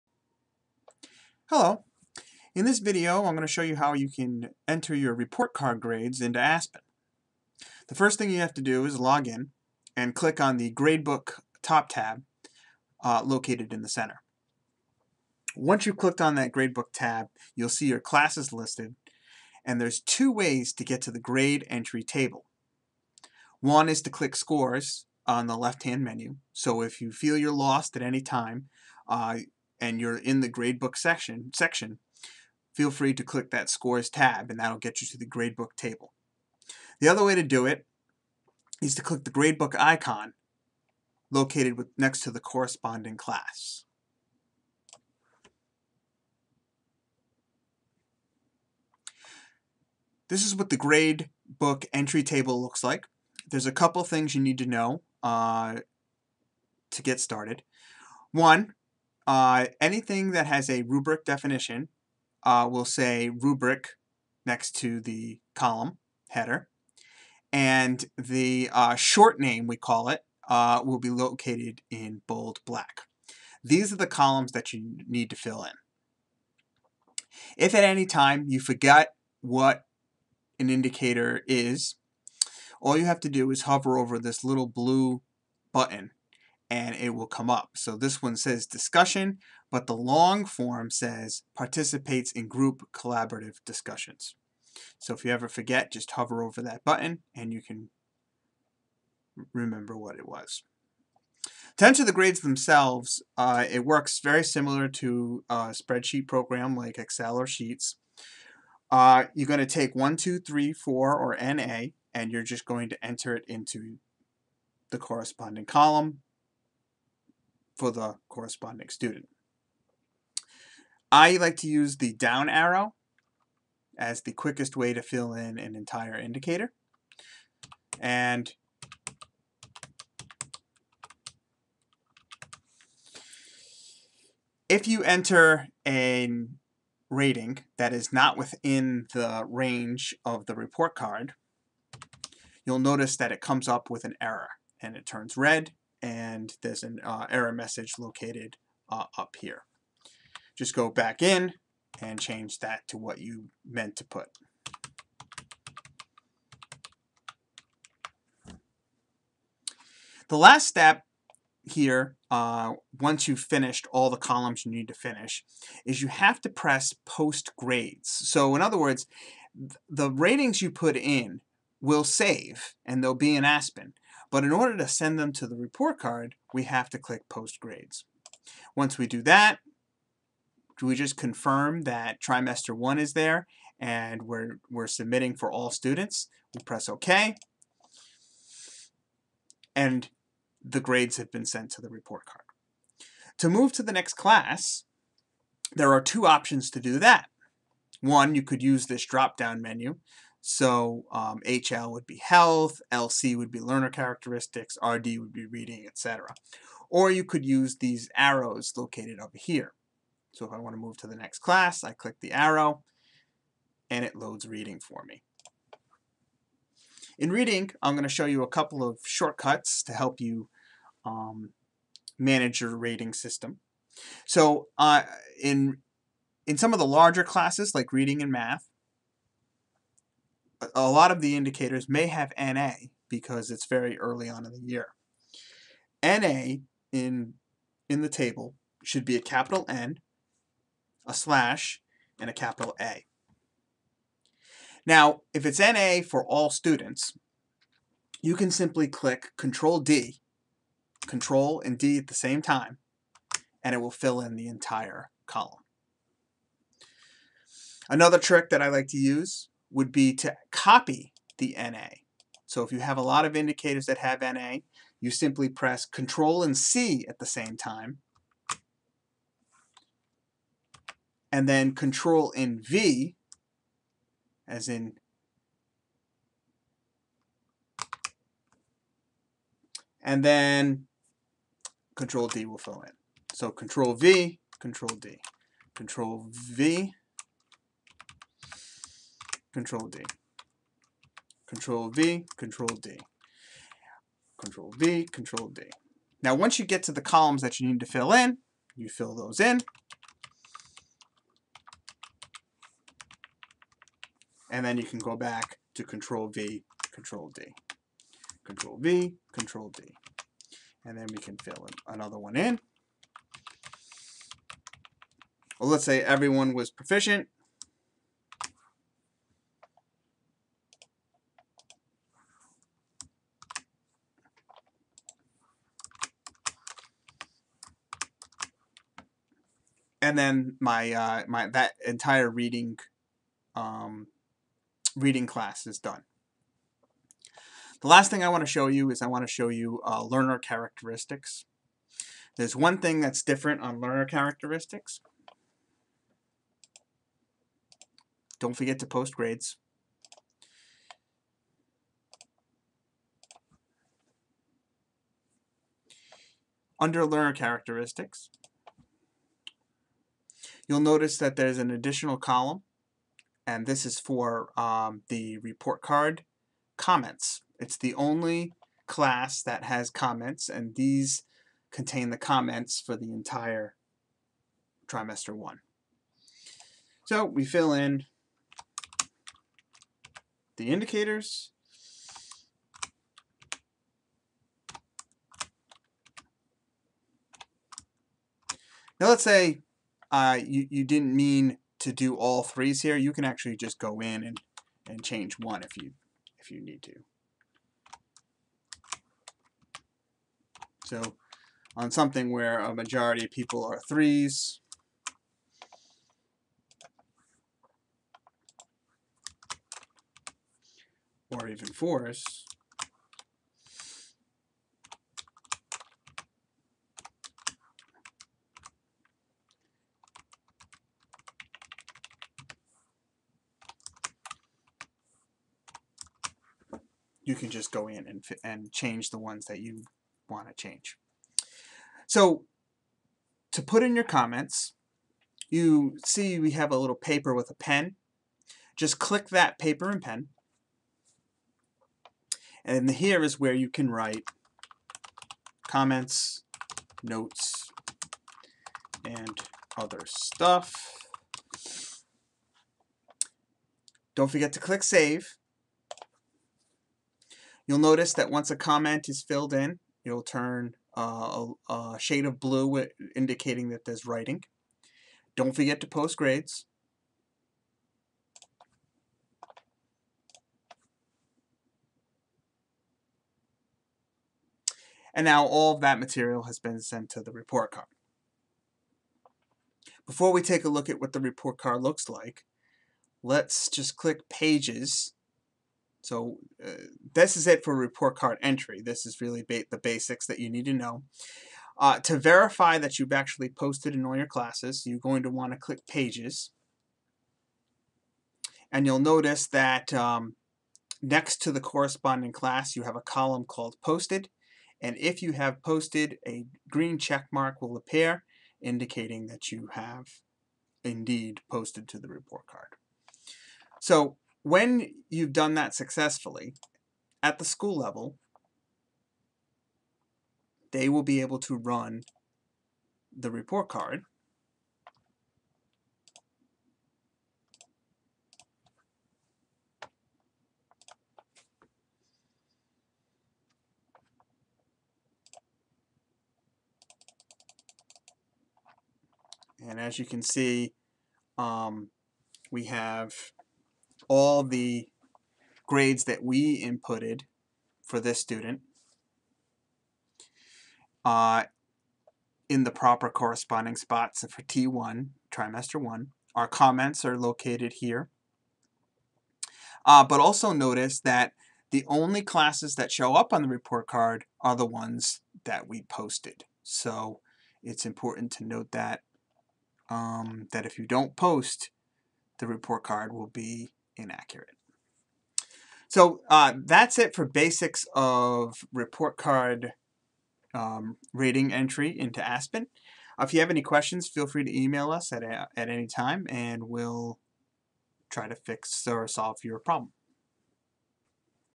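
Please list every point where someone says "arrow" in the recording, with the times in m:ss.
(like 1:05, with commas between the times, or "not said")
2:02, 3:28, 3:32.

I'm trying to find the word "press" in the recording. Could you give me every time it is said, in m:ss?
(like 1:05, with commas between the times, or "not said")
2:46, 3:06, 4:25.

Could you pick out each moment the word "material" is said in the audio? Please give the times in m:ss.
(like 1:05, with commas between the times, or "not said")
7:55.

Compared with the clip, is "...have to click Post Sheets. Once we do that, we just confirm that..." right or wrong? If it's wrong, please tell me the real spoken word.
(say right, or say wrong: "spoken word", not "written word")
wrong: "Grades", not "Sheets".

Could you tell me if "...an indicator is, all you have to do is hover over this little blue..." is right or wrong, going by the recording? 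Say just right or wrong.
right.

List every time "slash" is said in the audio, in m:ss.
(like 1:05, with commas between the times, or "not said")
4:01.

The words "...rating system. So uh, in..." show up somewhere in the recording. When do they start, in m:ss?
3:42.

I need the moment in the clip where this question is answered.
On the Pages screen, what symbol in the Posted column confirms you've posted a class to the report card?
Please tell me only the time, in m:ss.
8:26.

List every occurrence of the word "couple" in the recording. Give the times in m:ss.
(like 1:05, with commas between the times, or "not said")
0:53, 3:38.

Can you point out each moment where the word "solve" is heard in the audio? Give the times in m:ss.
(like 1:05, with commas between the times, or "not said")
9:49.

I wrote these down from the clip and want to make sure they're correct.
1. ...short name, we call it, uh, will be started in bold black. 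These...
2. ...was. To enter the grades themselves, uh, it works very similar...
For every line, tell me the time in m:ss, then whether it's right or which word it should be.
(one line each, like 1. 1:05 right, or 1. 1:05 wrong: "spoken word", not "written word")
1. 1:08 wrong: "located", not "started"
2. 1:40 right.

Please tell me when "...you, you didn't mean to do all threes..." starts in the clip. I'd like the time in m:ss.
6:30.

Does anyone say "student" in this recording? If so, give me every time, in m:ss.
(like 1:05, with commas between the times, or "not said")
1:58, 3:05, 4:06, 9:08.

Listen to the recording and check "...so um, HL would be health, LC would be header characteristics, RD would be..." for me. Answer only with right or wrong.
wrong.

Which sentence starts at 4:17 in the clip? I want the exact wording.
Another trick that I like to use would be to copy the NA.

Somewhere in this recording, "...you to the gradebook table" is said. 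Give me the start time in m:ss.
0:35.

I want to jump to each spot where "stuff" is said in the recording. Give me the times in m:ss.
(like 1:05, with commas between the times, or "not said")
7:30.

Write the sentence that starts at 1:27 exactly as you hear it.
So this one says discussion, but the long form says participates in group collaborative discussions.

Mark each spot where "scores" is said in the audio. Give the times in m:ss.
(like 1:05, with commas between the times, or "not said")
0:24, 0:33.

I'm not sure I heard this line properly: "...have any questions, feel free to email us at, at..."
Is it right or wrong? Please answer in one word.
right.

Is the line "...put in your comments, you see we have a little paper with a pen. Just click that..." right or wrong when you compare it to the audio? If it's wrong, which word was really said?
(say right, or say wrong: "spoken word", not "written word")
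right.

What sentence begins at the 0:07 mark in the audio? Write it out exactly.
The first thing you have to do is log in and click on the Gradebook top tab uh, located in the center.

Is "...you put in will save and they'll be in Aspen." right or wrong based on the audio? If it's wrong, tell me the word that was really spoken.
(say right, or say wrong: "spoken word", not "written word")
right.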